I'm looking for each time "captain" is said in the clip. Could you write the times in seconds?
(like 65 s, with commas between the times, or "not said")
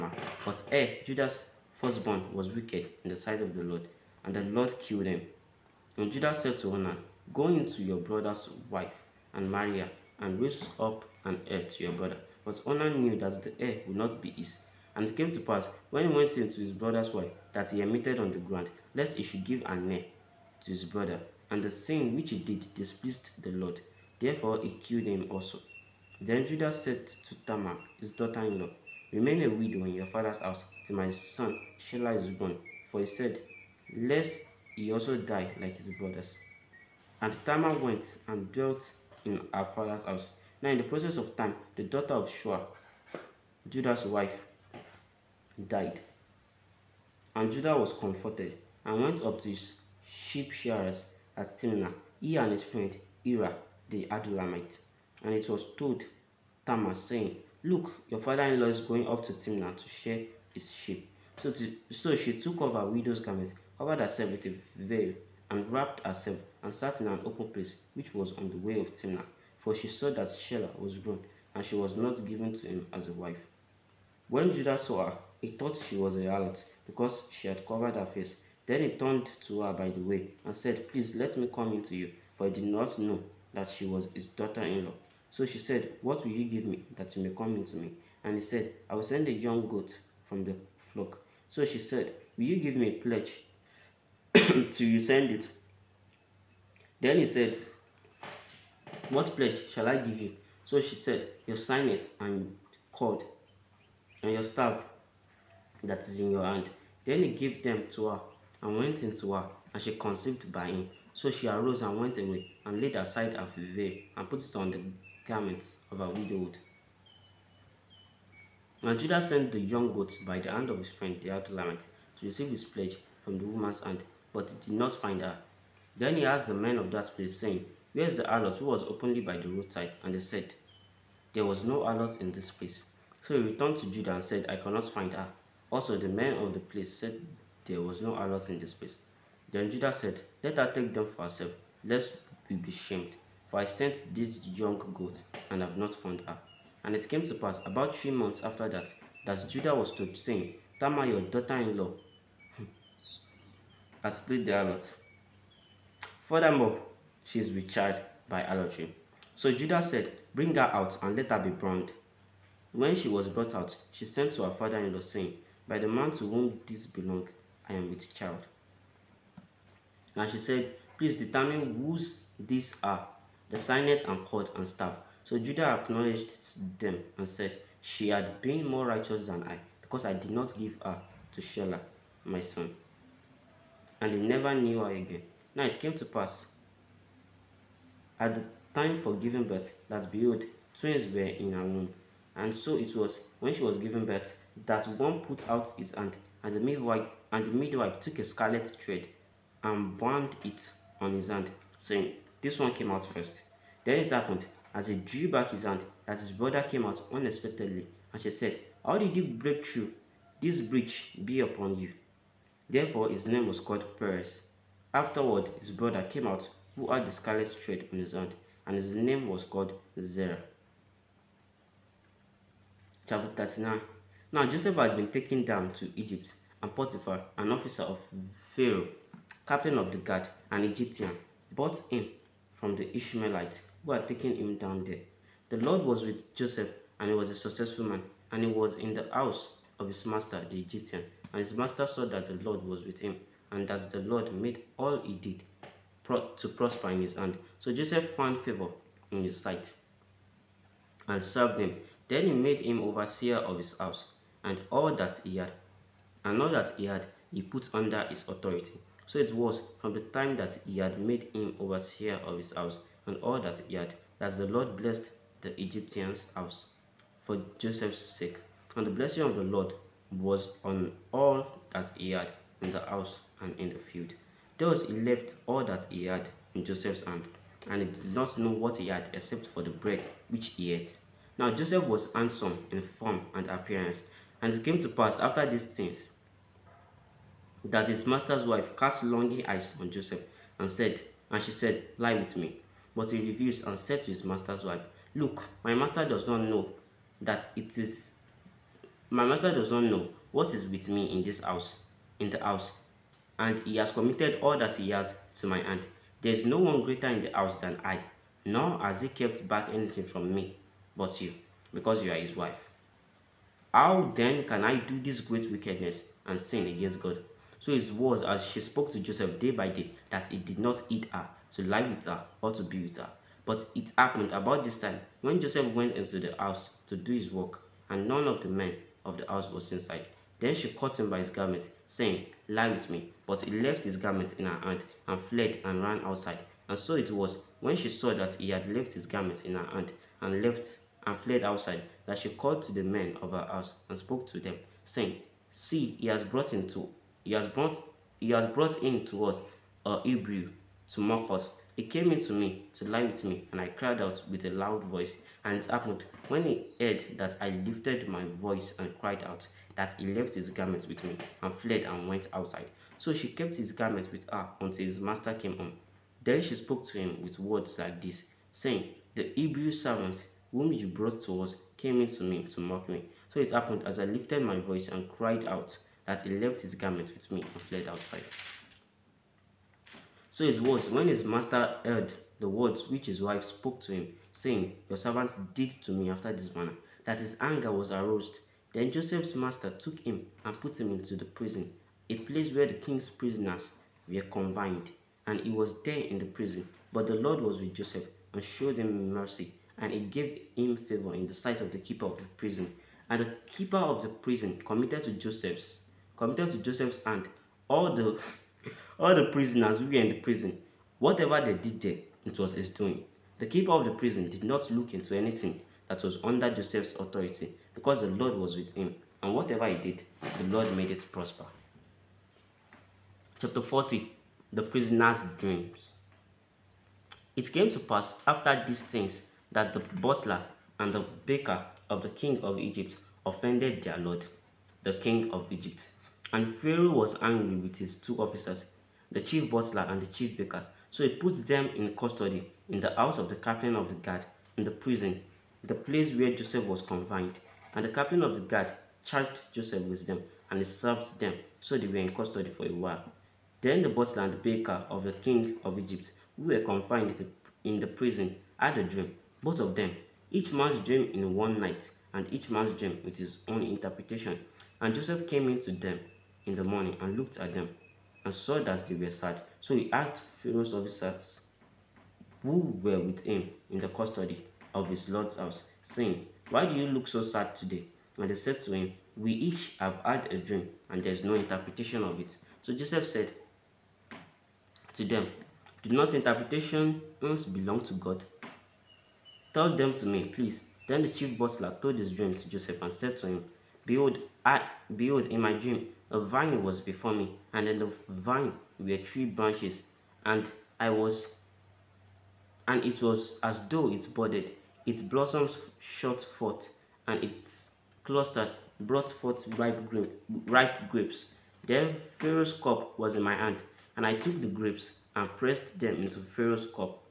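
229 s, 443 s, 447 s.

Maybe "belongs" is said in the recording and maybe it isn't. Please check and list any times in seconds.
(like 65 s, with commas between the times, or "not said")
166 s, 487 s.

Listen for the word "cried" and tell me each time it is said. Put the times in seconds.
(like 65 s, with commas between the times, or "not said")
353 s, 358 s, 375 s.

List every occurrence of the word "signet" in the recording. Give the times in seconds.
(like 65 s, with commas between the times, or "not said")
101 s, 173 s.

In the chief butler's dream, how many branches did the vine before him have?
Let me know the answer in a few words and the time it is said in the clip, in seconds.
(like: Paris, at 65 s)
3, at 498 s.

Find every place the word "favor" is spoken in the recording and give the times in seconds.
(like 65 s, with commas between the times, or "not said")
248 s, 400 s.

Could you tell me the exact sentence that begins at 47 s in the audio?
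And Judah was comforted and went up to his sheep shearers at Timnah, he and his friend Ira the Adullamite.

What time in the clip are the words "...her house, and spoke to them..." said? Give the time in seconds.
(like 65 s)
343 s.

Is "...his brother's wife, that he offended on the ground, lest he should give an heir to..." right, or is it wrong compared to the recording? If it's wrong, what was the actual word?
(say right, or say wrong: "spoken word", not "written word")
wrong: "emitted", not "offended".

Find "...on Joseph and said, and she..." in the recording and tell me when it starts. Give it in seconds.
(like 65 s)
289 s.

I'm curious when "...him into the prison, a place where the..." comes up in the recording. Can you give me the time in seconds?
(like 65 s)
390 s.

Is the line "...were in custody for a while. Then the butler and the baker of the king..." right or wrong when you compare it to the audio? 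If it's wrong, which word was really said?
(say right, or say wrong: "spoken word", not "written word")
right.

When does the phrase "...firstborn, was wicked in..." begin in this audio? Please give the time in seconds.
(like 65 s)
1 s.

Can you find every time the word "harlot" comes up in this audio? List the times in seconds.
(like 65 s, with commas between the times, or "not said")
76 s, 154 s.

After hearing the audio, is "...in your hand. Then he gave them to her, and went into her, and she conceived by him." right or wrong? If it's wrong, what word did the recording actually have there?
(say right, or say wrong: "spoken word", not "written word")
right.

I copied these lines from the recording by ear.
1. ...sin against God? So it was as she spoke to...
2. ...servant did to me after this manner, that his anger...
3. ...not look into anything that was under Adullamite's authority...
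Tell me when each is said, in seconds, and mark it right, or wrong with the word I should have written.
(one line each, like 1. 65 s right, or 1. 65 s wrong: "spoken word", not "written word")
1. 316 s right
2. 384 s right
3. 414 s wrong: "Joseph", not "Adullamite".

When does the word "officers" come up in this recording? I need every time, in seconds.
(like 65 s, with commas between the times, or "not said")
227 s, 438 s, 470 s.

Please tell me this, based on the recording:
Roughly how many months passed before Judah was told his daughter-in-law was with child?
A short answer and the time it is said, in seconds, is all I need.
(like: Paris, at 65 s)
3, at 147 s.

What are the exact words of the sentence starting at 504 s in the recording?
Its blossoms shot forth, and its clusters brought forth ripe, grape, ripe grapes.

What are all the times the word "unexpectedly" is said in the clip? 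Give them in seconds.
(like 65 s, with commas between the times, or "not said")
207 s.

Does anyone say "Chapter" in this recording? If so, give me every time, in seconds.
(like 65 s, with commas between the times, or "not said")
223 s, 423 s.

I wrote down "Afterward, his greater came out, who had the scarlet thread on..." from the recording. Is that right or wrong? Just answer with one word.
wrong.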